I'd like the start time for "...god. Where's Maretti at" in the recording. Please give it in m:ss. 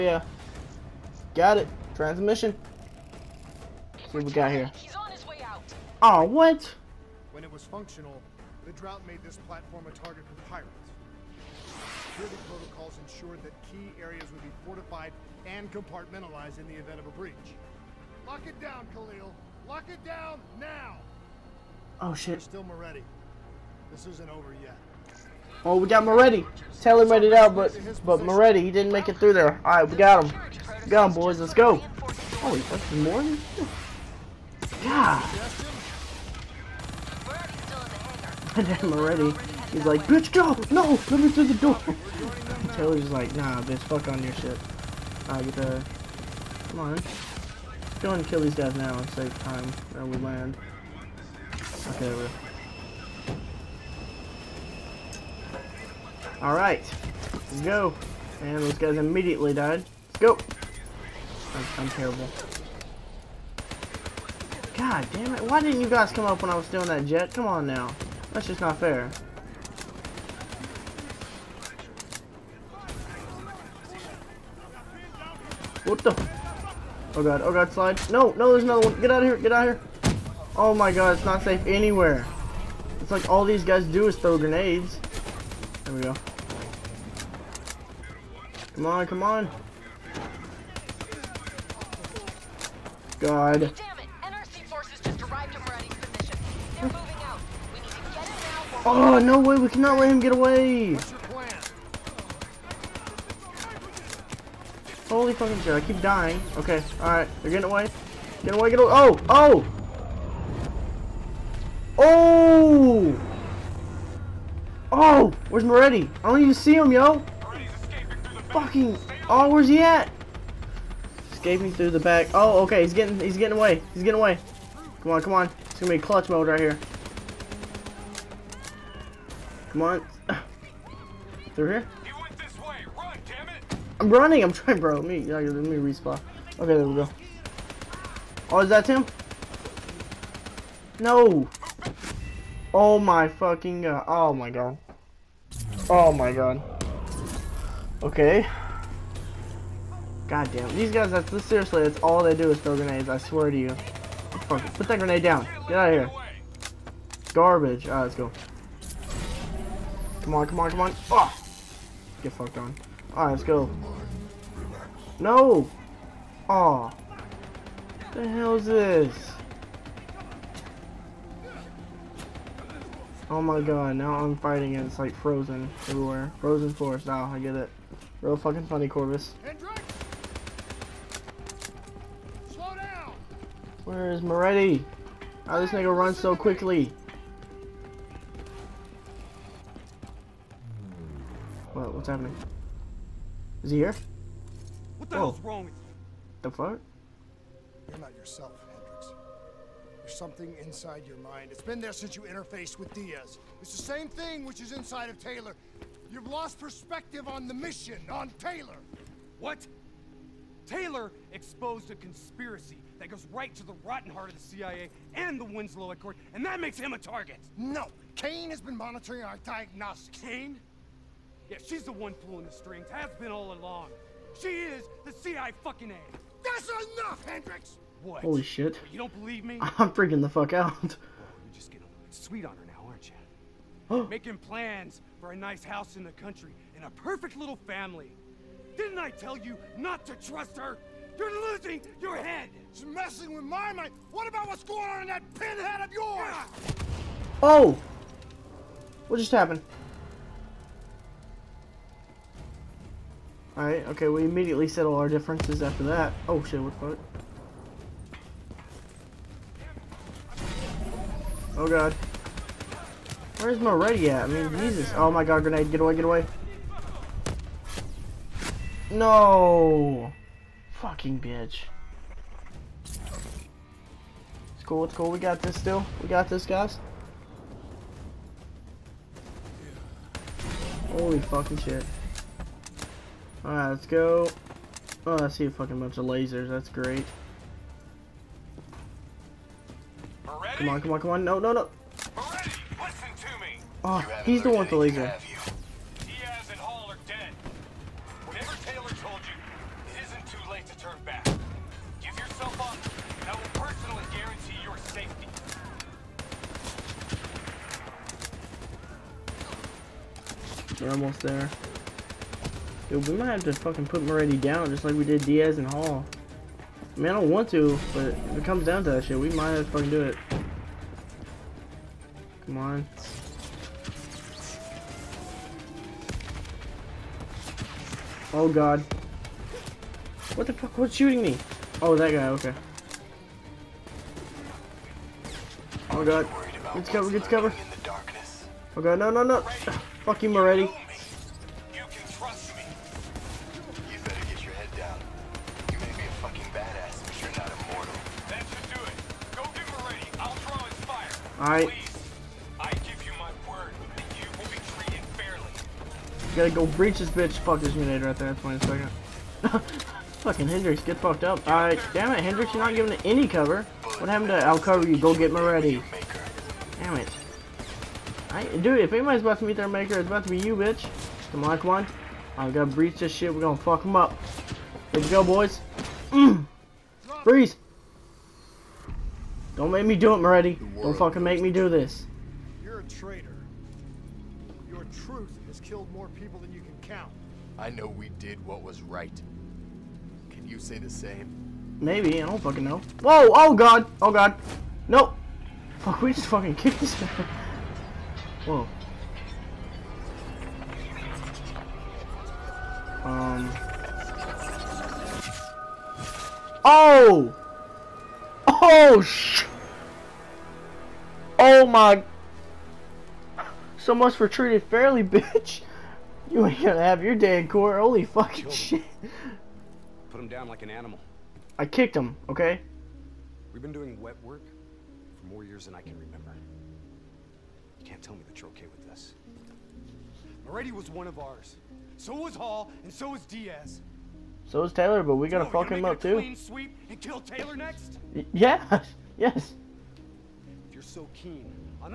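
4:21.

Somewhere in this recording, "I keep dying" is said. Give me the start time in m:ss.
1:45.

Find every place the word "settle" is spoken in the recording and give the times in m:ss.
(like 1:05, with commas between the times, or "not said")
4:14.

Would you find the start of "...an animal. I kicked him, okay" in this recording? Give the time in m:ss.
7:00.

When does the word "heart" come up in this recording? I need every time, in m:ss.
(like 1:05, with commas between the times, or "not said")
3:34.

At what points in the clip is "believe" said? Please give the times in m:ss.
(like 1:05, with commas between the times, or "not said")
3:49.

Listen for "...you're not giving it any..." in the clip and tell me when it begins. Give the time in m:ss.
6:02.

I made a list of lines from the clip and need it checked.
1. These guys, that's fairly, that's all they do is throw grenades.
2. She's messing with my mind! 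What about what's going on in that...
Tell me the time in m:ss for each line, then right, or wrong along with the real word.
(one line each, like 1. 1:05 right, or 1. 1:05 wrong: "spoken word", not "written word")
1. 2:30 wrong: "seriously", not "fairly"
2. 4:02 right.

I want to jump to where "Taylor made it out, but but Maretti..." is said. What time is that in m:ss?
0:26.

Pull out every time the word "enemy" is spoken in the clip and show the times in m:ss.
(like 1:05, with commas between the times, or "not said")
not said.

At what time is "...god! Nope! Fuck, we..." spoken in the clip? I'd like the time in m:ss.
6:34.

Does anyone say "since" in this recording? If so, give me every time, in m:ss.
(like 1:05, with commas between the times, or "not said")
3:21.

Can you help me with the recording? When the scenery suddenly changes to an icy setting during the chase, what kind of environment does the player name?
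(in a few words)
Frozen forest.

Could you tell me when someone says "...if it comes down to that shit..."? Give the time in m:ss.
5:18.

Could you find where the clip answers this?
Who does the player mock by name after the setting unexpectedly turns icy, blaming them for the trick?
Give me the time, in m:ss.
2:58.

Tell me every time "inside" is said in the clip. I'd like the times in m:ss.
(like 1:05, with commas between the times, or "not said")
3:20, 3:24.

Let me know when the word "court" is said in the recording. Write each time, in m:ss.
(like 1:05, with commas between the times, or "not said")
6:57.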